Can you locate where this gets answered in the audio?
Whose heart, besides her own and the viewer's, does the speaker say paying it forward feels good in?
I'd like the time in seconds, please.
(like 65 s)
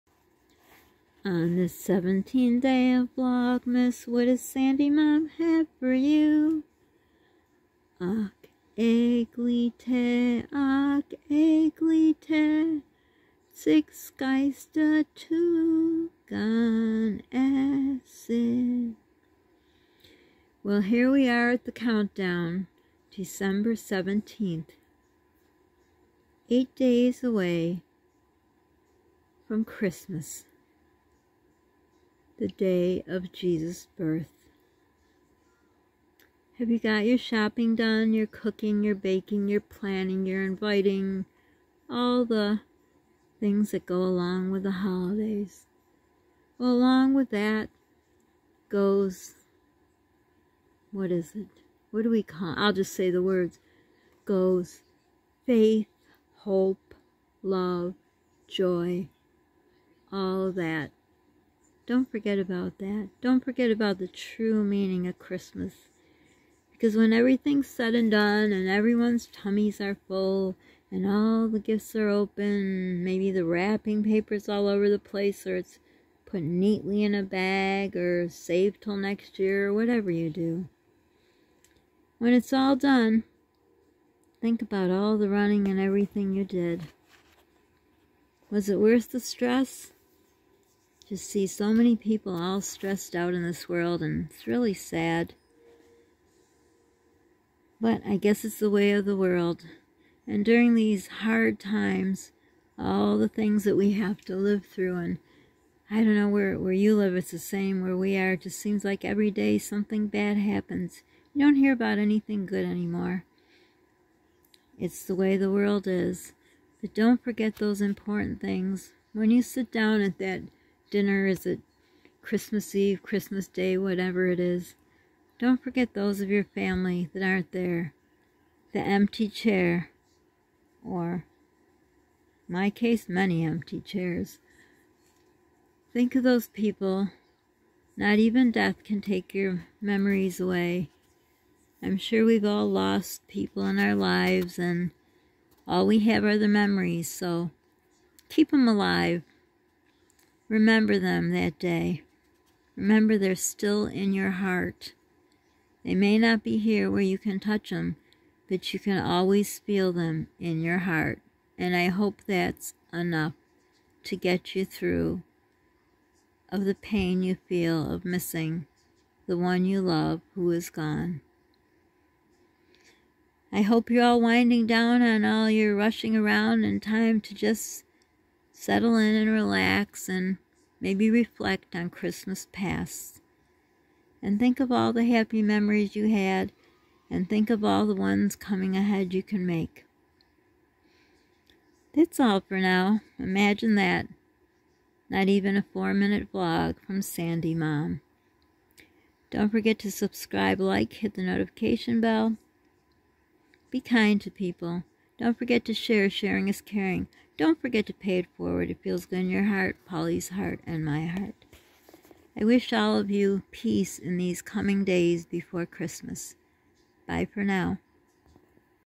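209 s.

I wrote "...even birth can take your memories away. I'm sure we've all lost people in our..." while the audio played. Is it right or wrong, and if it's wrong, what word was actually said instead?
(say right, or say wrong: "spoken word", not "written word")
wrong: "death", not "birth".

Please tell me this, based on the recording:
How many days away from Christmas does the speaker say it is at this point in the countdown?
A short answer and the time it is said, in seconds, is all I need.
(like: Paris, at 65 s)
8, at 26 s.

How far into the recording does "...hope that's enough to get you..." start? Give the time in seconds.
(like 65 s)
161 s.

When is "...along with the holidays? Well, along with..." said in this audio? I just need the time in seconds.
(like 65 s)
43 s.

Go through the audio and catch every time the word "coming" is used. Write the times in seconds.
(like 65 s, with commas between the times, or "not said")
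188 s, 214 s.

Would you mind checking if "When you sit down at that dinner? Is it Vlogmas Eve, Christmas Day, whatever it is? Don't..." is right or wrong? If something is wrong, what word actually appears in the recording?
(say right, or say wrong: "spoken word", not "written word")
wrong: "Christmas", not "Vlogmas".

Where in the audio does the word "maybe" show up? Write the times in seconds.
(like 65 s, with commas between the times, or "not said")
73 s, 180 s.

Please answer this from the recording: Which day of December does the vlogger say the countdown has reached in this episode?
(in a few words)
December 17th.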